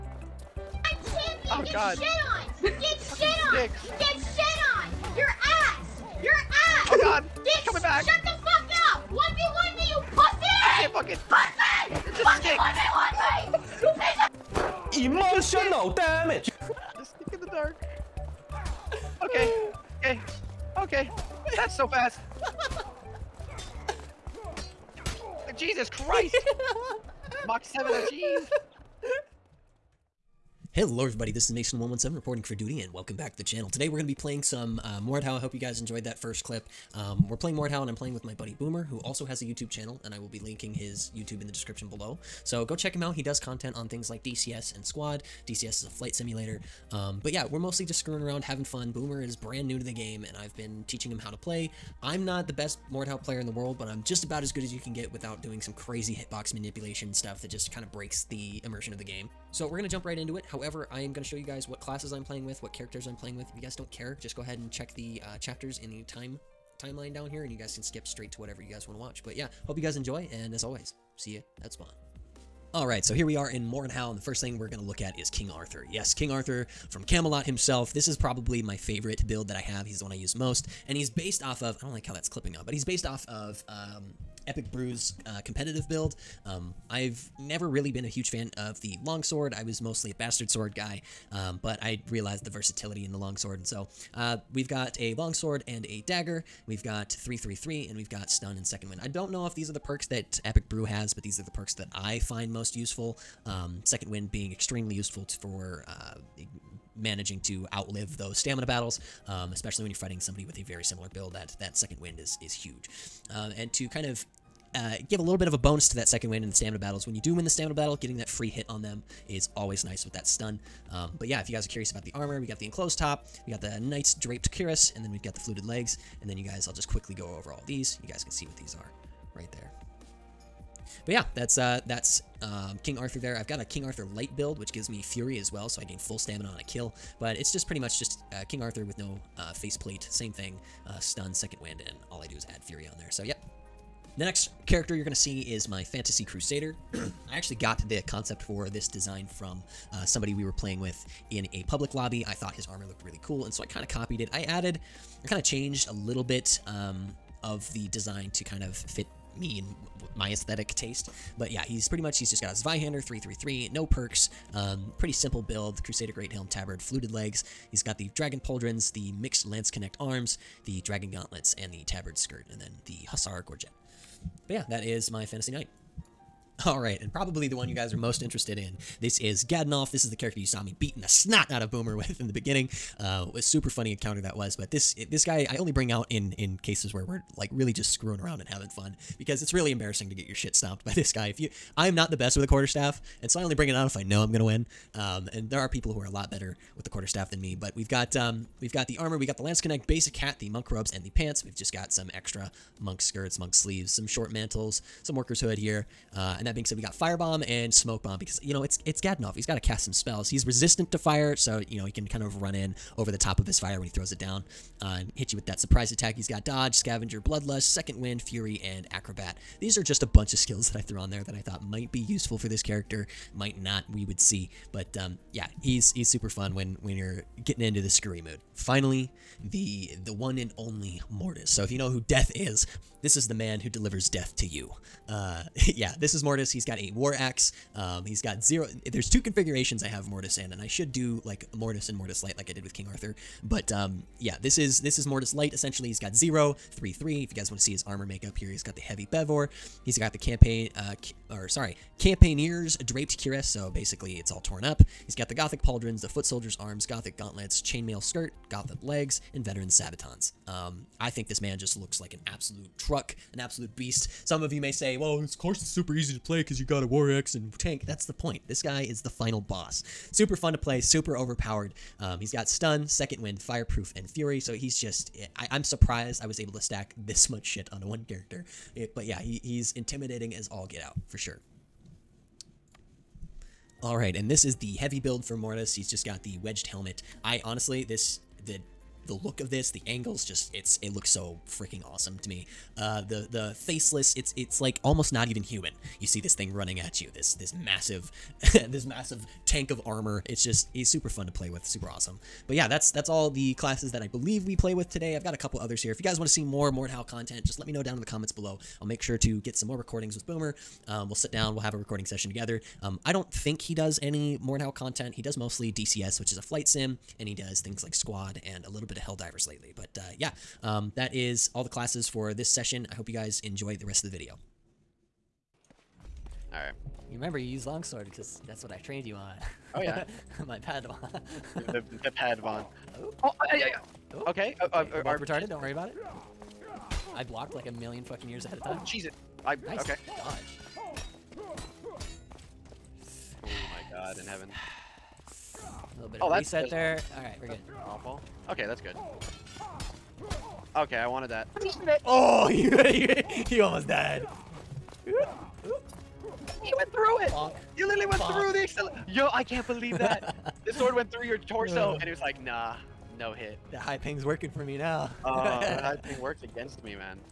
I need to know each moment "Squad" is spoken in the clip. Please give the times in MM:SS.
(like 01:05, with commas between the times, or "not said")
00:44, 05:17.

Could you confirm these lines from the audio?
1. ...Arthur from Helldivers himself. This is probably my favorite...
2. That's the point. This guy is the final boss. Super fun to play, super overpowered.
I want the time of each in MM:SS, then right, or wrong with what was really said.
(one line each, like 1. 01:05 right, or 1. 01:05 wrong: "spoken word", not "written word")
1. 01:16 wrong: "Camelot", not "Helldivers"
2. 04:27 right.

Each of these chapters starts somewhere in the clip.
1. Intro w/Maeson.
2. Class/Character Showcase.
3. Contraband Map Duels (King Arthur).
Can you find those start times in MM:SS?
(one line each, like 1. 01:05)
1. 00:29
2. 01:12
3. 05:25.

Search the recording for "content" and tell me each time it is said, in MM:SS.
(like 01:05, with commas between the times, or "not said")
00:43, 05:07, 05:14.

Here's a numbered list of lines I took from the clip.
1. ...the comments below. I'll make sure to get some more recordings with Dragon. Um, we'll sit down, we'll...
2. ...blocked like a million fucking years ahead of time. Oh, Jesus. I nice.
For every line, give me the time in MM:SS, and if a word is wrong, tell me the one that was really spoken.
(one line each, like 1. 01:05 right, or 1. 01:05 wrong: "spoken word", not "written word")
1. 05:08 wrong: "Boomer", not "Dragon"
2. 05:37 right.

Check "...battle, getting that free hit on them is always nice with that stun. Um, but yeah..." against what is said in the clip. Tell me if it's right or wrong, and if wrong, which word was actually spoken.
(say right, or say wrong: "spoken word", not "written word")
right.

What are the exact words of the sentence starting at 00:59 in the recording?
So we're going to jump right into it.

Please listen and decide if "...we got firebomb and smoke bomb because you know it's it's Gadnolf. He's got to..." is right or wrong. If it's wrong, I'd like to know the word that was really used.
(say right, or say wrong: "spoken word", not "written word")
right.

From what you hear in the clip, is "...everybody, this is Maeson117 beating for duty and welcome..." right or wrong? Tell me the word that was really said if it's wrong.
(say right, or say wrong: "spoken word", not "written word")
wrong: "reporting", not "beating".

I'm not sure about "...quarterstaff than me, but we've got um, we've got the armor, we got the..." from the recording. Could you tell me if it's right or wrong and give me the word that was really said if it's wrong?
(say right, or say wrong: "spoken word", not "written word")
right.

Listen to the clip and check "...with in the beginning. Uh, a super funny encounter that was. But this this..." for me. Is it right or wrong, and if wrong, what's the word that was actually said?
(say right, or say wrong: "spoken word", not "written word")
right.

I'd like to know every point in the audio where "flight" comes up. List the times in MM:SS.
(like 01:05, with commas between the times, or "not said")
00:45, 05:16.